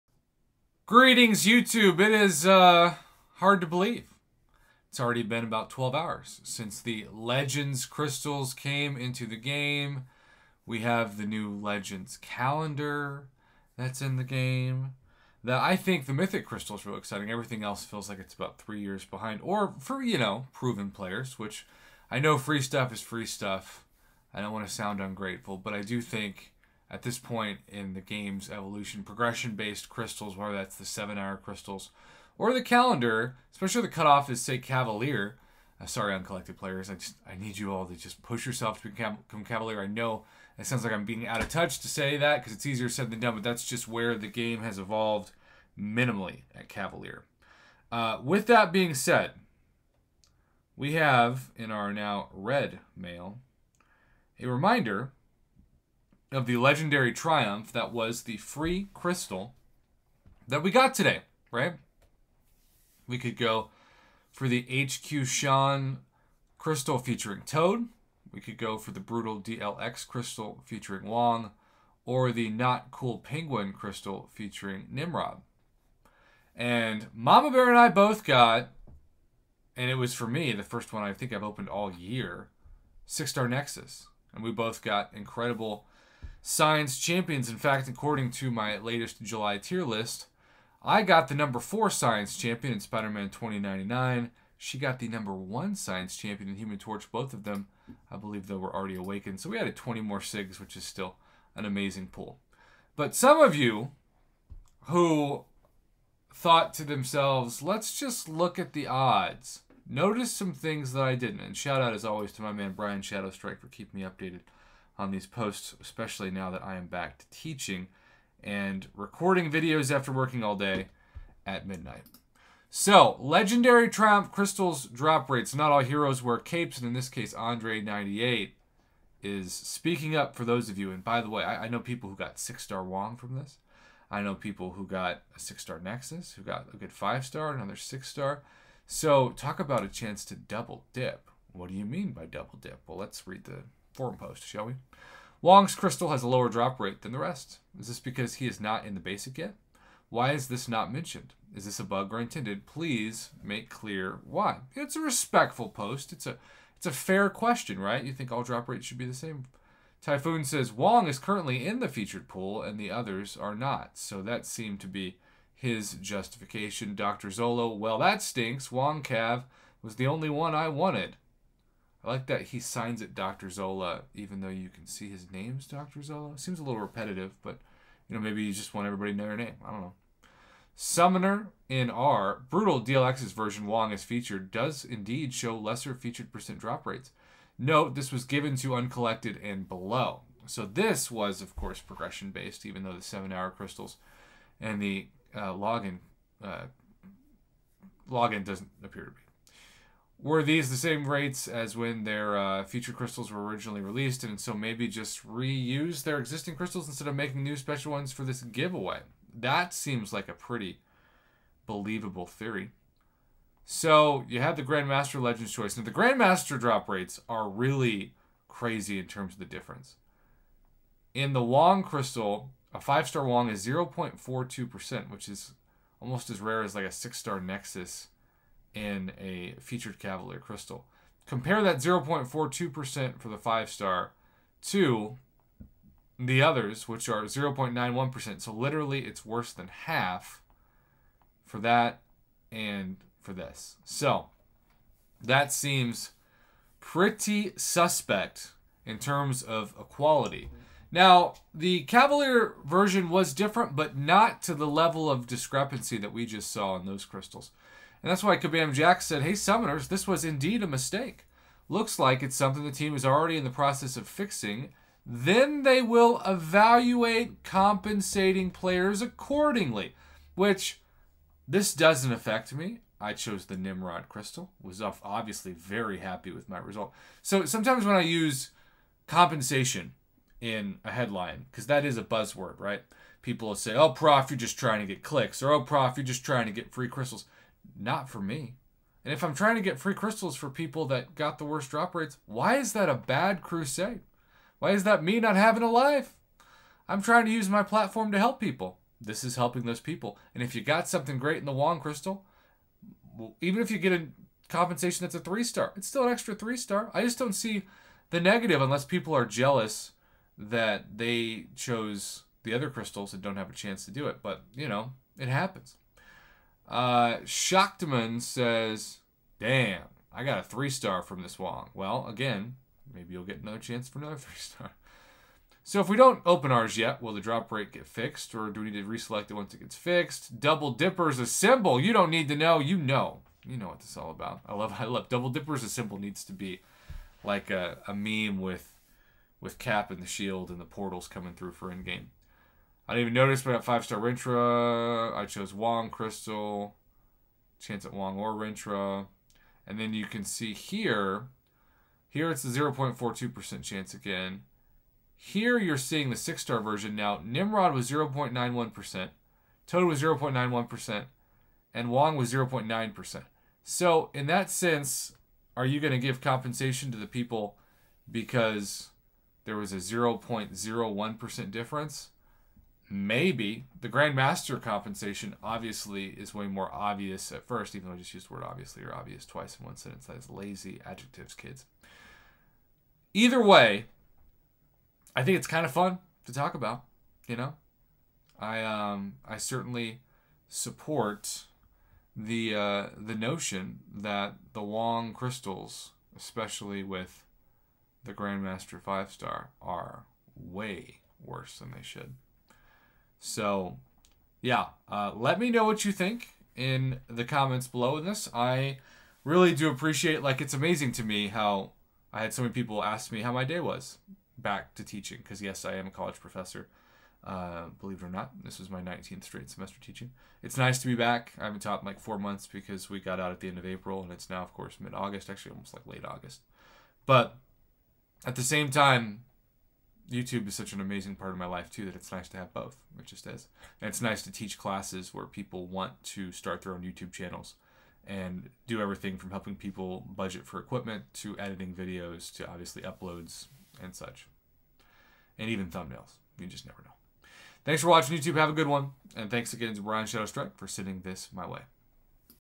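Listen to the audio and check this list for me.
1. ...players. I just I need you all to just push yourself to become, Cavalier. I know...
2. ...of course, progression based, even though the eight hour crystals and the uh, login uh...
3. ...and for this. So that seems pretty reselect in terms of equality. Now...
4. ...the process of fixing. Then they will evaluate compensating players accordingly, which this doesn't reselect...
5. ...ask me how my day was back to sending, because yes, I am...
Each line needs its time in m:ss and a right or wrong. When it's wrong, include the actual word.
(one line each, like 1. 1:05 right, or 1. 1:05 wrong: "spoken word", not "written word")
1. 0:36 right
2. 3:11 wrong: "seven", not "eight"
3. 4:02 wrong: "suspect", not "reselect"
4. 4:23 wrong: "affect", not "reselect"
5. 6:52 wrong: "teaching", not "sending".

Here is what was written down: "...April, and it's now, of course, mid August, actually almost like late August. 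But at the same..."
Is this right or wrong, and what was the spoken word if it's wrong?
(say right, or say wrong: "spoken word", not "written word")
right.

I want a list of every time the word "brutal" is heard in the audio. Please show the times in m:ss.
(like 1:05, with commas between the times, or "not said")
1:09, 3:02.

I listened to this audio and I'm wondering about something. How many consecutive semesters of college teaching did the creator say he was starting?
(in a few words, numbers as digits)
19.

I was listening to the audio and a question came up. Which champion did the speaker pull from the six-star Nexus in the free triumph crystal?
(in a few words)
Spider Man 2099.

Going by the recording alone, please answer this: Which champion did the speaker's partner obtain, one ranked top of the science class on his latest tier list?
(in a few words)
Human Torch.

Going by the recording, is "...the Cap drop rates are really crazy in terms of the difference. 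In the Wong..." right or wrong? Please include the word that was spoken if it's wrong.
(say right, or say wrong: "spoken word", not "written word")
wrong: "Grandmaster", not "Cap".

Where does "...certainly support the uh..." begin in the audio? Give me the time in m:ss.
6:29.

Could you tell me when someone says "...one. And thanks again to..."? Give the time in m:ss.
7:28.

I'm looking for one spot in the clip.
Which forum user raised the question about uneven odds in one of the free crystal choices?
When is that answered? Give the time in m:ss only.
2:07.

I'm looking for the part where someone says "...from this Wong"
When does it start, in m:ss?
5:21.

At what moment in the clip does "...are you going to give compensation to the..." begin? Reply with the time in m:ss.
6:05.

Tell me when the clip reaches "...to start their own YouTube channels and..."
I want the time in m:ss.
7:16.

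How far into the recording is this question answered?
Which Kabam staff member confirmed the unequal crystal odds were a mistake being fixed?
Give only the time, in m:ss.
4:18.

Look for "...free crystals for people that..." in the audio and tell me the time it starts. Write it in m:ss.
4:49.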